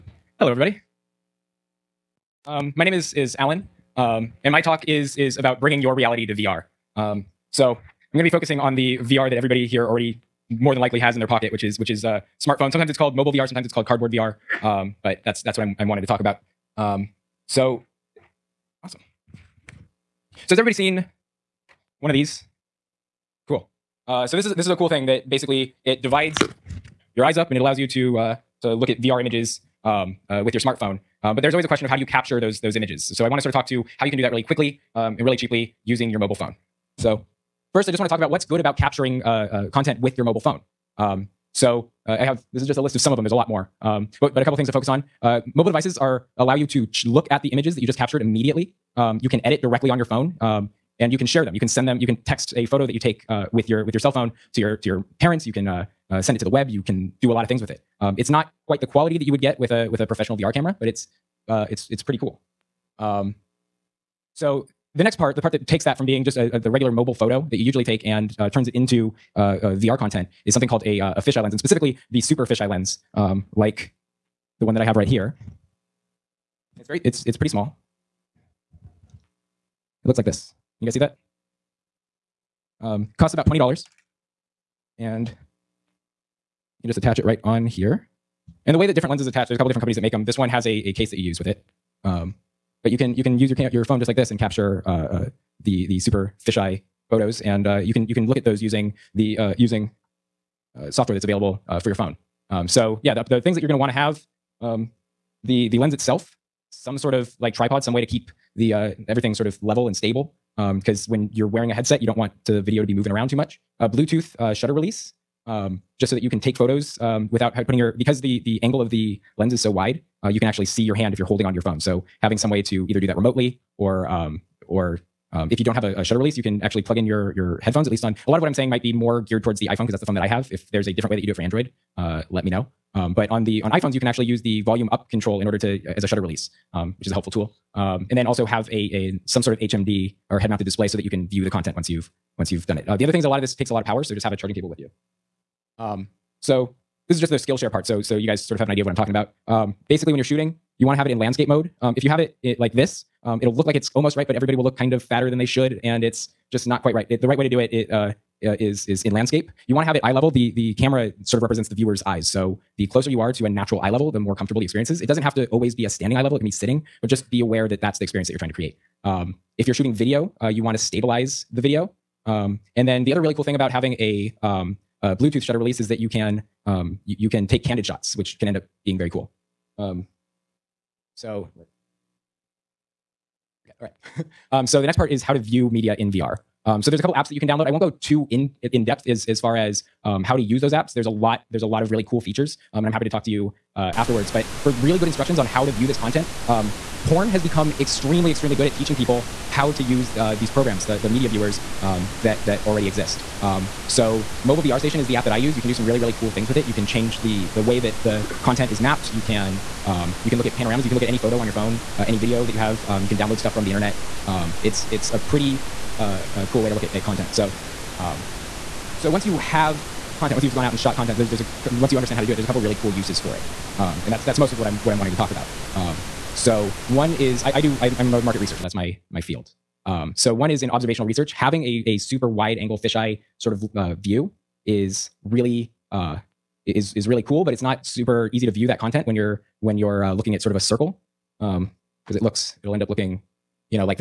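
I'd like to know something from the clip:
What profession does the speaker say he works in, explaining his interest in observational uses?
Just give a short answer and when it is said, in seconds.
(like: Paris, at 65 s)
market researcher, at 228 s.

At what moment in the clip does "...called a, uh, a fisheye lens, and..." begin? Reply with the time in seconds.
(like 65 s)
70 s.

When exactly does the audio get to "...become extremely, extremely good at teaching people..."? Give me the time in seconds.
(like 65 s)
197 s.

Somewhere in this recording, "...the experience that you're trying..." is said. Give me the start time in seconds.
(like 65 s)
167 s.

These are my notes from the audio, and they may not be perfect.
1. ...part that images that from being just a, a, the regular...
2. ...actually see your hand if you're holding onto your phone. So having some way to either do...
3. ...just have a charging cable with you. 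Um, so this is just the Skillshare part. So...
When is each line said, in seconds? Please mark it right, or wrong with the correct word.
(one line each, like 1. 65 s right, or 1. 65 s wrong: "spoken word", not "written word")
1. 65 s wrong: "takes", not "images"
2. 120 s right
3. 144 s right.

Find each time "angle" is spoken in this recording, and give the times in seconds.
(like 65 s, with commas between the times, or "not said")
118 s, 232 s.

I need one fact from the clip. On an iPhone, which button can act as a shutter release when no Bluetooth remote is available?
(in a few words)
volume up.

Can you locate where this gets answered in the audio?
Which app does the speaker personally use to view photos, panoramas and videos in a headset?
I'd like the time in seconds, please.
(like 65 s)
204 s.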